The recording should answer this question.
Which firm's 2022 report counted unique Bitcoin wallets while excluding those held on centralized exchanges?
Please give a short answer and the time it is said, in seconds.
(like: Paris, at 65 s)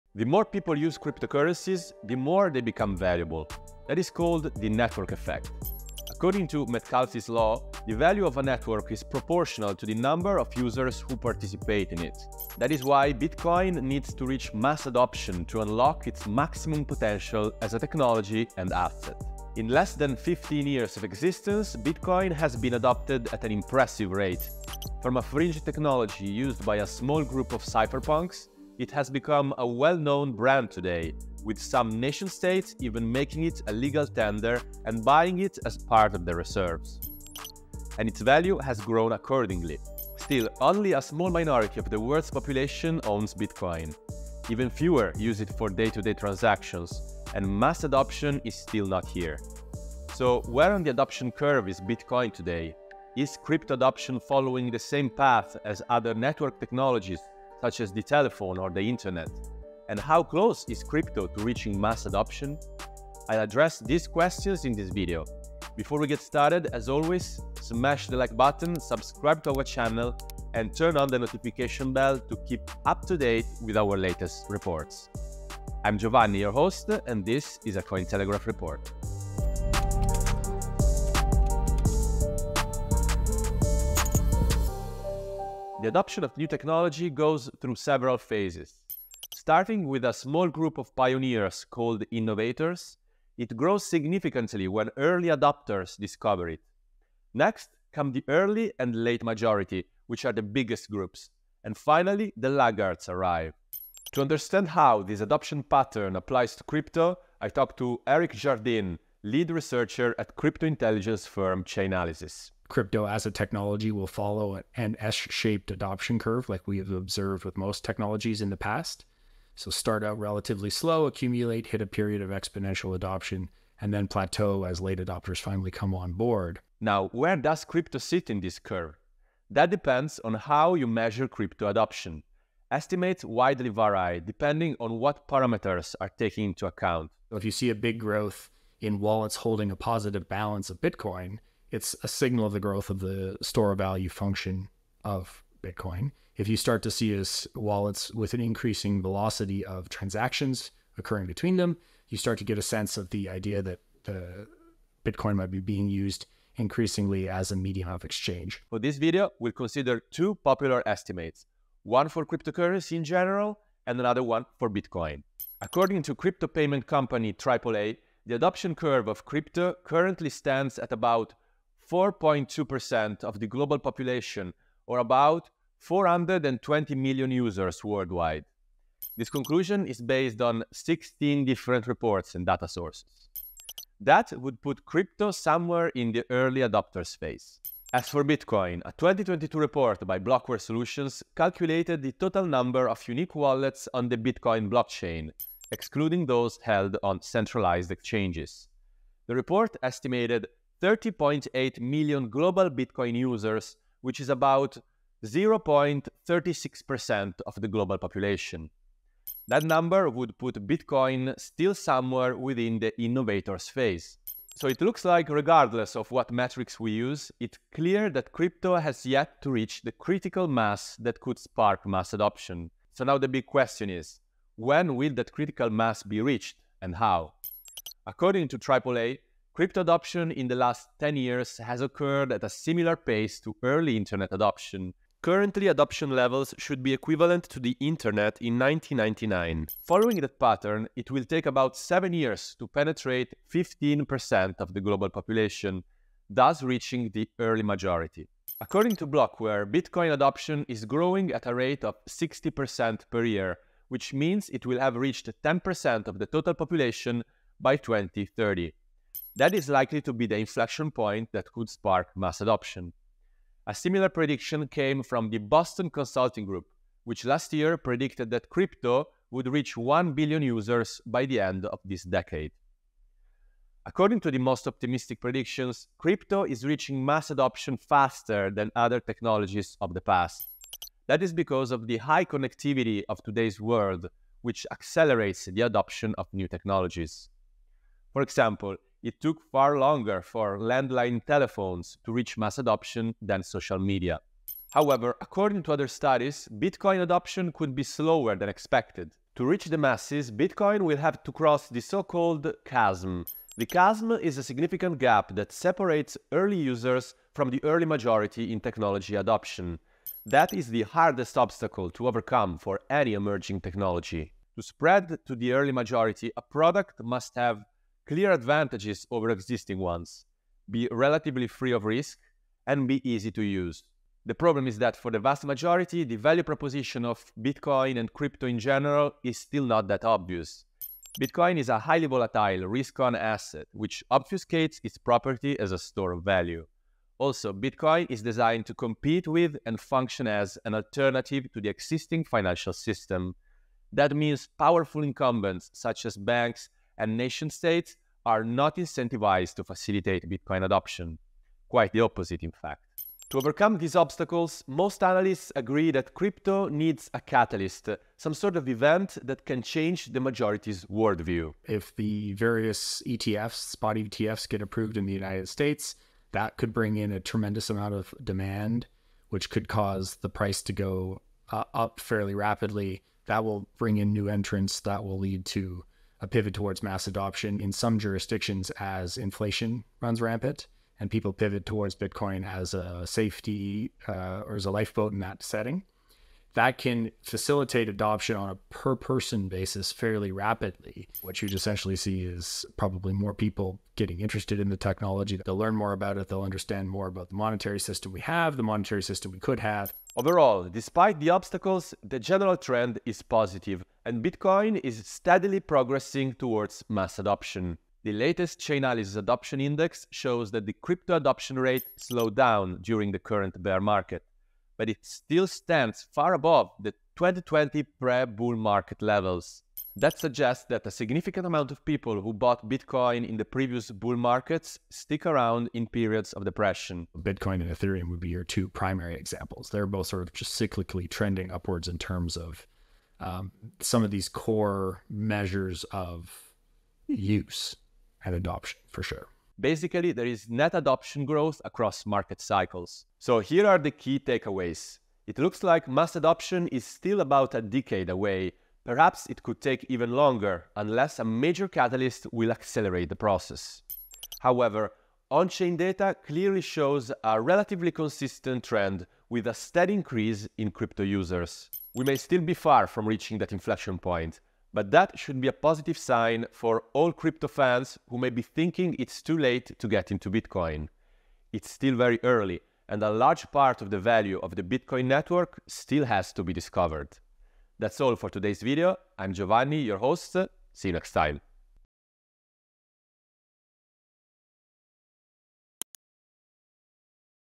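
Blockware Solutions, at 190 s.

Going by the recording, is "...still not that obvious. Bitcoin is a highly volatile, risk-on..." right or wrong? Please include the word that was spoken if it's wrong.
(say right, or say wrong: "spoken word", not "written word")
right.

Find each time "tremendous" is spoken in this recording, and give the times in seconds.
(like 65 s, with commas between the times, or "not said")
367 s.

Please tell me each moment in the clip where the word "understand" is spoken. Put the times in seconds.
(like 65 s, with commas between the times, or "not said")
104 s, 396 s.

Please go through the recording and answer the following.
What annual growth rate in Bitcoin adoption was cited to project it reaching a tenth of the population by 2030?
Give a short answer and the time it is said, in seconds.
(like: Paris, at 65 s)
60%, at 252 s.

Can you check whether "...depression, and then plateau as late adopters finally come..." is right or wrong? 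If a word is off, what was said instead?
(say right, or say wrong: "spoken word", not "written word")
wrong: "adoption", not "depression".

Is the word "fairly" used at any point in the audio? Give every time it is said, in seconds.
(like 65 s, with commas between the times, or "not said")
372 s, 389 s.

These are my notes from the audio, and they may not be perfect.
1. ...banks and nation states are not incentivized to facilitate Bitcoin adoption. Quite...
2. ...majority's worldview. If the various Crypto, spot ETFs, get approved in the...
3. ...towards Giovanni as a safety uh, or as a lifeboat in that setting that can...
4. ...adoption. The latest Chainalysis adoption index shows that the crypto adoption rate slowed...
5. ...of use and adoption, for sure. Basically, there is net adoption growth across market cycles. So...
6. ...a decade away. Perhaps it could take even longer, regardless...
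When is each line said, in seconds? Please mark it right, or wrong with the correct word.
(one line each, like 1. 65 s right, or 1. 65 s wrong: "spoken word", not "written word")
1. 346 s right
2. 360 s wrong: "ETFs", not "Crypto"
3. 381 s wrong: "Bitcoin", not "Giovanni"
4. 407 s right
5. 435 s right
6. 447 s wrong: "unless", not "regardless".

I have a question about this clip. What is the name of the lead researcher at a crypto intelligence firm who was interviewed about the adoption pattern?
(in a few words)
Eric Jardine.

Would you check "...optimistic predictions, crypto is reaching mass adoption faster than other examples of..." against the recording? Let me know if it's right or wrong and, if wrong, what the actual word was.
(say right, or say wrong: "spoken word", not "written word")
wrong: "technologies", not "examples".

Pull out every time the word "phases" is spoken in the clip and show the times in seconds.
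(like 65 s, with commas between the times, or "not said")
88 s, 213 s.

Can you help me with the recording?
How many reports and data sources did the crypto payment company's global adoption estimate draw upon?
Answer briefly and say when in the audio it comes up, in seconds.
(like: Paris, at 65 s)
16, at 180 s.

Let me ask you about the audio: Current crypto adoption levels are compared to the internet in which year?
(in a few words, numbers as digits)
1999.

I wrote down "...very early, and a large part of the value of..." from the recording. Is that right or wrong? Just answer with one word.
right.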